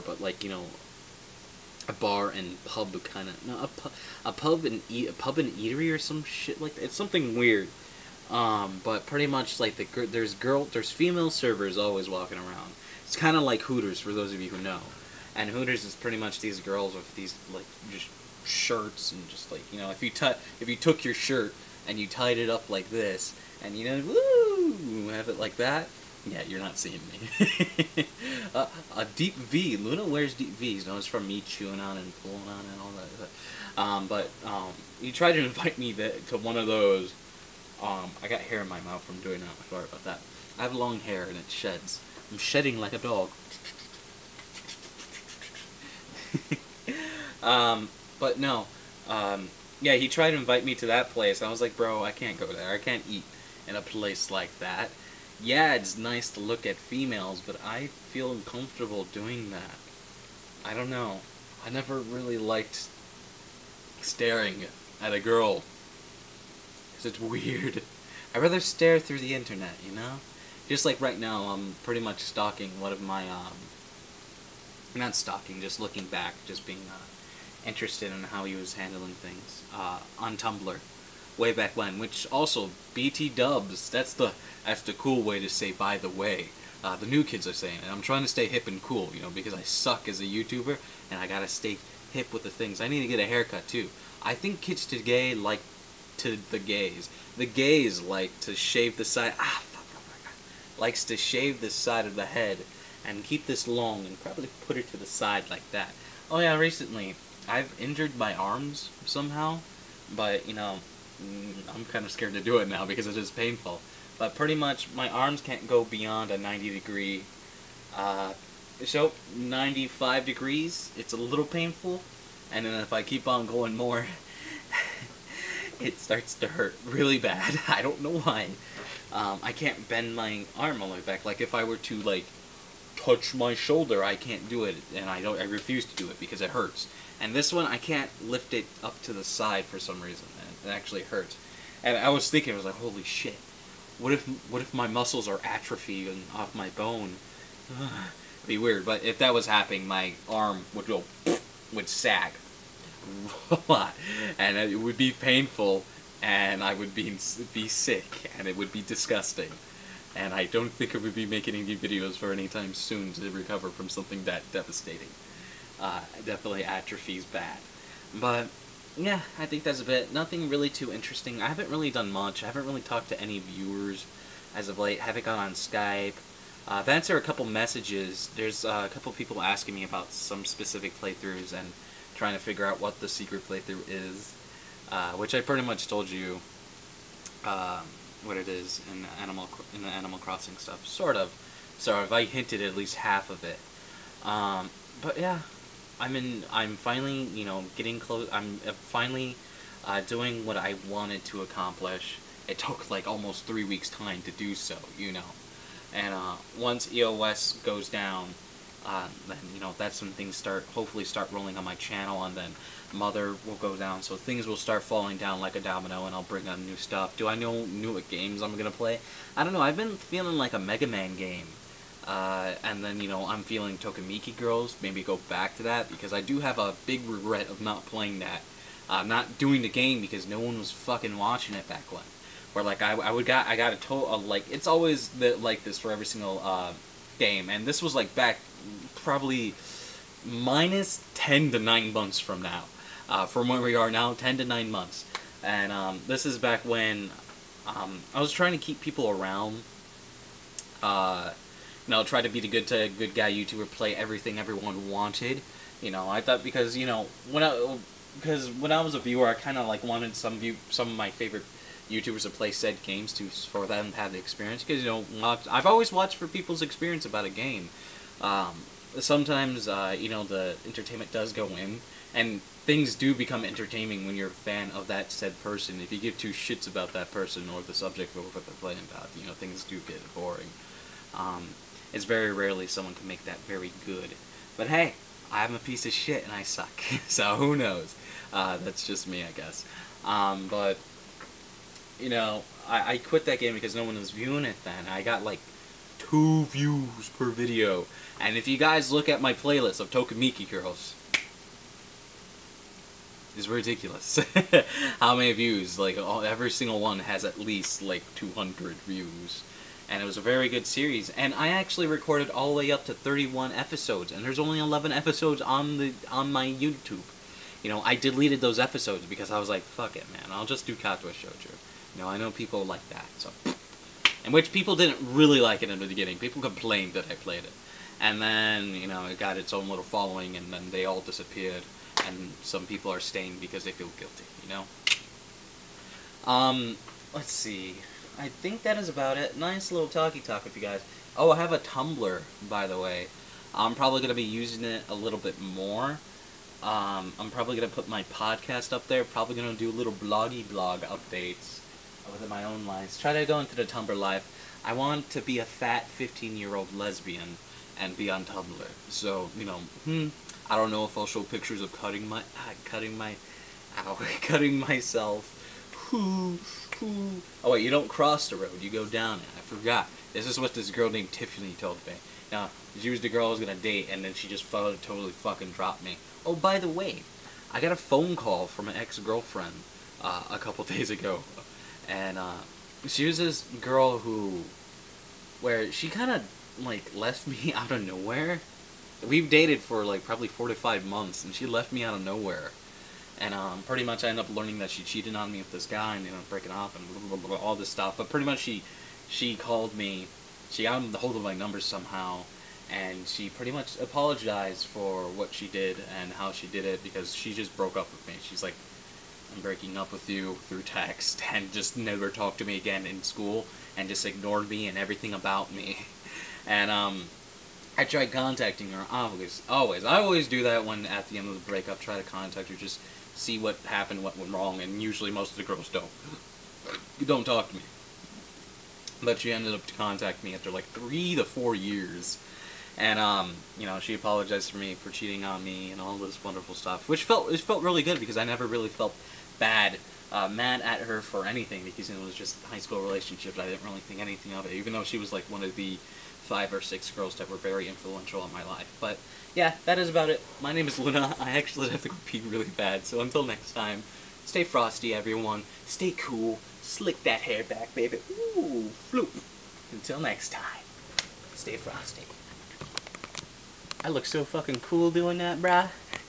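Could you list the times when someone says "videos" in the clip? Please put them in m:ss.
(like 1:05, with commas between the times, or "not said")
2:41, 4:57.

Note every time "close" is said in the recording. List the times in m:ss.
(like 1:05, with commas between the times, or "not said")
3:17.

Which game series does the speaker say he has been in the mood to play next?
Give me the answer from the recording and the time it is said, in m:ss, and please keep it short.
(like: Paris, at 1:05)
Mega Man, at 3:40.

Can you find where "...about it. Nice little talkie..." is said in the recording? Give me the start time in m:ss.
5:38.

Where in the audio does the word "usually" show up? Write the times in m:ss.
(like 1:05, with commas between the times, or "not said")
7:04.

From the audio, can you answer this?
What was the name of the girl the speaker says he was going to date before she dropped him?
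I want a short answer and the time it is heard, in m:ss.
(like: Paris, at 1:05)
Tiffany, at 6:11.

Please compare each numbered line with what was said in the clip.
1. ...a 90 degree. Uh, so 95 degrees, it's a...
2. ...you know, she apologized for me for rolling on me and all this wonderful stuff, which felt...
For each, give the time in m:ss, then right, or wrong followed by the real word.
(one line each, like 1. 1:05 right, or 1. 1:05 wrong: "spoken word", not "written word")
1. 1:56 right
2. 7:13 wrong: "cheating", not "rolling".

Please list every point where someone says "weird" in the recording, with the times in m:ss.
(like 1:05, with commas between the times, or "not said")
0:07, 1:07, 2:28.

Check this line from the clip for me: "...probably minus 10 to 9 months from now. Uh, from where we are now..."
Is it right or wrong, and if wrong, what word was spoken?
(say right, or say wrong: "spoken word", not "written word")
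right.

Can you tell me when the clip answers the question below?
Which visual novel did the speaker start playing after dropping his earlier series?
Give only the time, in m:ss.
5:20.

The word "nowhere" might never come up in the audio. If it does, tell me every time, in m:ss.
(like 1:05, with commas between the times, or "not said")
6:27, 6:32.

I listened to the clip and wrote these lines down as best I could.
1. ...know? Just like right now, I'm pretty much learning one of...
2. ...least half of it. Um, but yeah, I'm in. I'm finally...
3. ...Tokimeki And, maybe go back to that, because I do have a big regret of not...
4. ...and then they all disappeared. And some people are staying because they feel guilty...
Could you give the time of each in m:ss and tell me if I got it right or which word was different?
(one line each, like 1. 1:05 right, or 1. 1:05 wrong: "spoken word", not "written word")
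1. 1:09 wrong: "stalking", not "learning"
2. 3:12 right
3. 3:43 wrong: "Girls", not "And"
4. 5:30 right.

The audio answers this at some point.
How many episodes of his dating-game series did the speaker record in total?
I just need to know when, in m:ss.
5:12.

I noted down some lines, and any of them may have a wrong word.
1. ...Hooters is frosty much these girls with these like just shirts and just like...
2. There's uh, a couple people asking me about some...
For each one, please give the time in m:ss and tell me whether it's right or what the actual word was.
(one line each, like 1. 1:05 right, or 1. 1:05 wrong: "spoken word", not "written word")
1. 0:15 wrong: "pretty", not "frosty"
2. 2:58 right.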